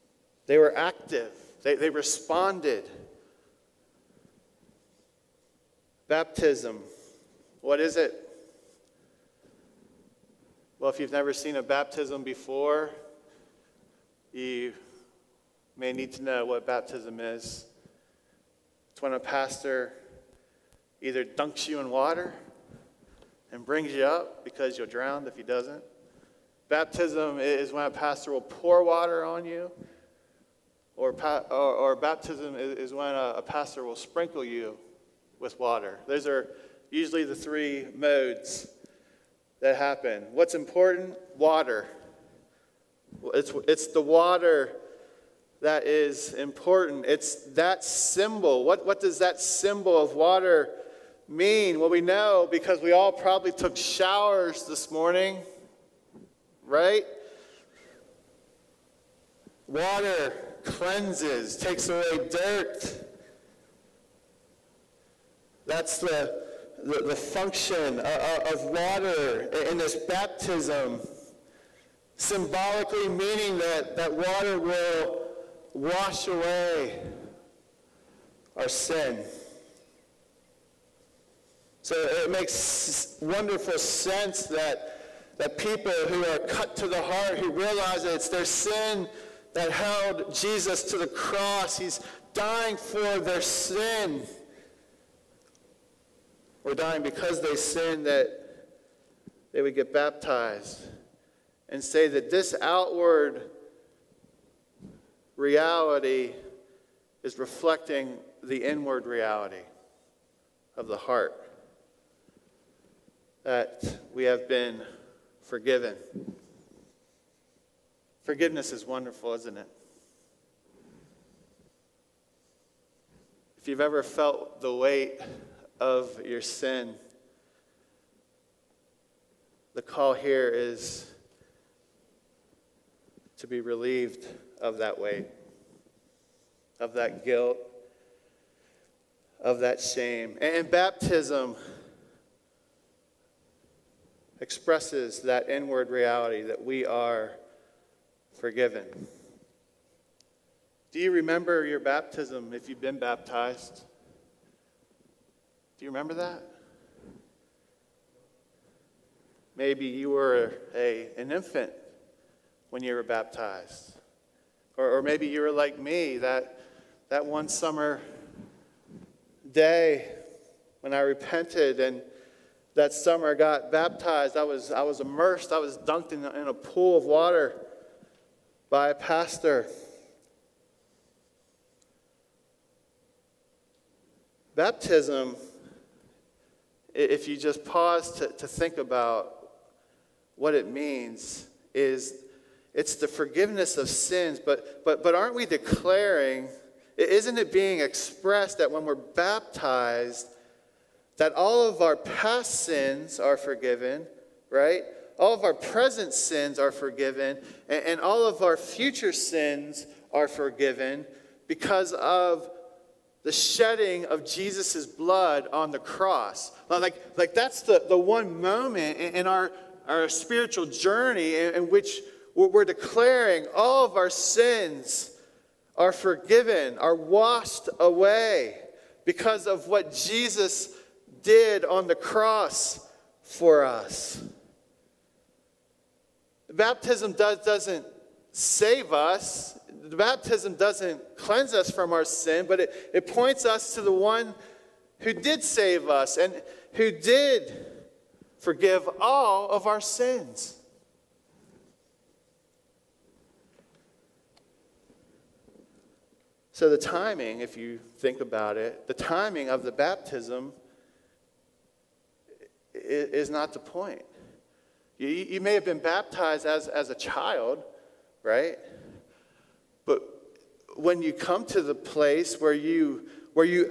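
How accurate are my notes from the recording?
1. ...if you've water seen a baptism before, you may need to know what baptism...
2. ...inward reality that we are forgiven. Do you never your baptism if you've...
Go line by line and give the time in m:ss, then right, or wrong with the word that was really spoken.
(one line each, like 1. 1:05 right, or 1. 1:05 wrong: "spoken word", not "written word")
1. 0:10 wrong: "never", not "water"
2. 2:25 wrong: "remember", not "never".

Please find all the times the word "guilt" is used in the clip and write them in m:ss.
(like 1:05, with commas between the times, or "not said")
2:17.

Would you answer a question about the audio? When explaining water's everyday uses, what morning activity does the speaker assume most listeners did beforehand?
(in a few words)
took showers.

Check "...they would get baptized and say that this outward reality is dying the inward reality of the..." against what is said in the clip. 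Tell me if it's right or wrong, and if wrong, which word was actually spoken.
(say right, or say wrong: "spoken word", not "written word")
wrong: "reflecting", not "dying".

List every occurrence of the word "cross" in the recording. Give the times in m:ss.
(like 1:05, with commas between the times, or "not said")
1:31, 3:35, 3:51.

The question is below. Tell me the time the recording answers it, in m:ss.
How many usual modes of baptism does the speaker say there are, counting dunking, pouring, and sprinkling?
0:37.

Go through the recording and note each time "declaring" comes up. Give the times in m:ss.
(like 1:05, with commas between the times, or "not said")
3:15, 3:42.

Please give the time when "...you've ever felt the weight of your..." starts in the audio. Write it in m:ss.
2:03.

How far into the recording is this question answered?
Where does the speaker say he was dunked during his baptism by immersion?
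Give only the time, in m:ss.
2:56.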